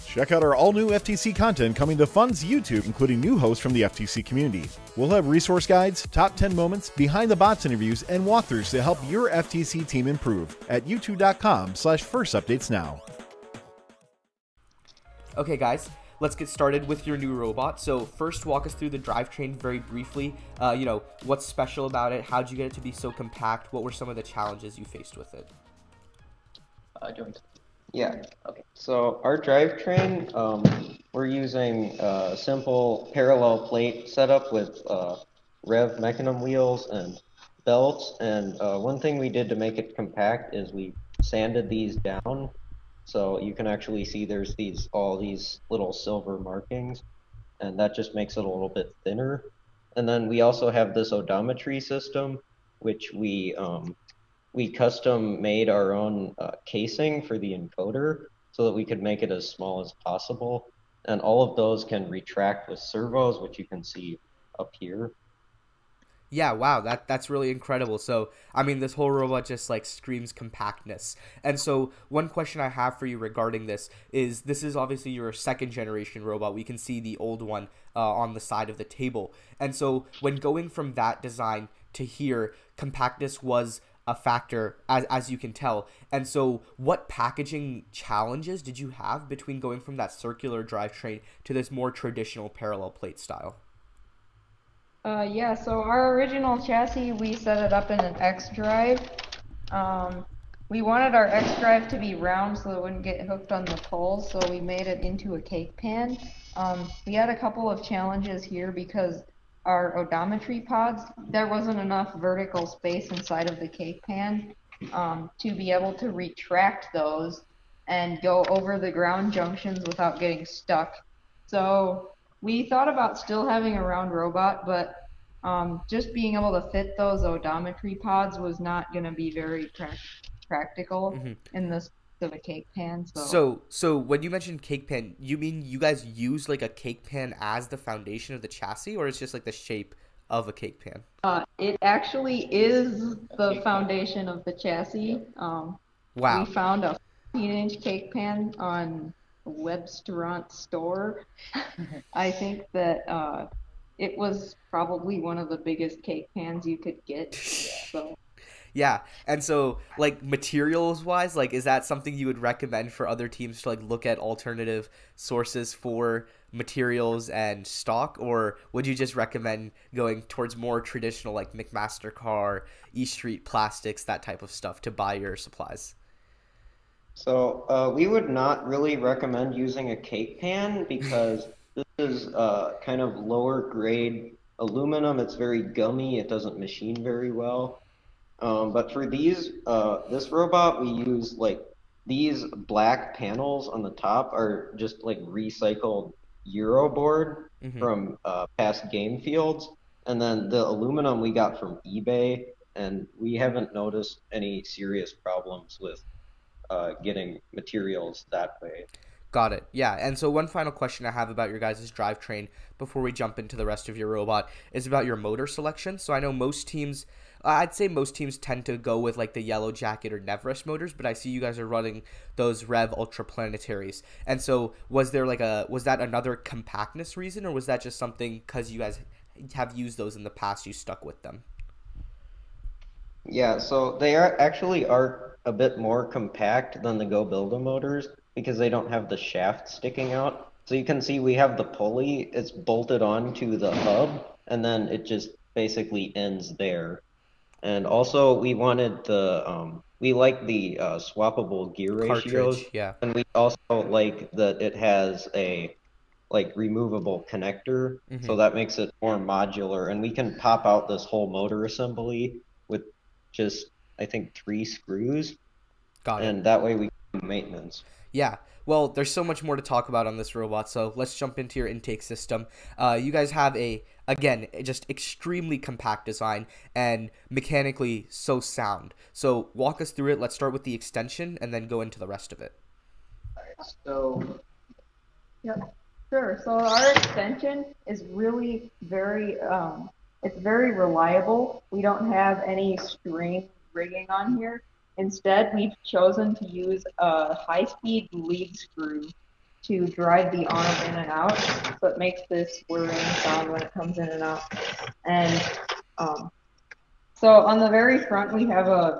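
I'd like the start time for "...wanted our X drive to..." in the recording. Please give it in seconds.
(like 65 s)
100 s.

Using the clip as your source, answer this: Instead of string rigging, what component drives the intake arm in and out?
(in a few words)
high-speed lead screw.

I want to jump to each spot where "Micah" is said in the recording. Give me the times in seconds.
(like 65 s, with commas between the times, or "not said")
not said.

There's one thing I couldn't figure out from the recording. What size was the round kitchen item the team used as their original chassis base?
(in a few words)
15-inch.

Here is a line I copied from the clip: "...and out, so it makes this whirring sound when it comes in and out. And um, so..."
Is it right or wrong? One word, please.
right.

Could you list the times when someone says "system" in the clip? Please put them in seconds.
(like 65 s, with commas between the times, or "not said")
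51 s, 272 s.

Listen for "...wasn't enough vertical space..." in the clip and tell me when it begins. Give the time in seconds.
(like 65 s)
111 s.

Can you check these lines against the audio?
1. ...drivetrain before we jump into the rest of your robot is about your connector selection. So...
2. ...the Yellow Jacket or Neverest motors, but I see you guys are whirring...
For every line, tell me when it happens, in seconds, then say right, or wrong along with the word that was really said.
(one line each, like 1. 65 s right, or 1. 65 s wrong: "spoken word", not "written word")
1. 211 s wrong: "motor", not "connector"
2. 219 s wrong: "running", not "whirring".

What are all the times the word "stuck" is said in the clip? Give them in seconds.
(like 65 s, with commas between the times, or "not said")
120 s, 230 s.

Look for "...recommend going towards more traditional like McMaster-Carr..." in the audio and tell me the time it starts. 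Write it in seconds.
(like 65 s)
169 s.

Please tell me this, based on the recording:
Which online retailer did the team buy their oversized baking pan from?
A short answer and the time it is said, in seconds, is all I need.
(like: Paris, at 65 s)
Webstaurant Store, at 149 s.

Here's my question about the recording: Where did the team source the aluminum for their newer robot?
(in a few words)
eBay.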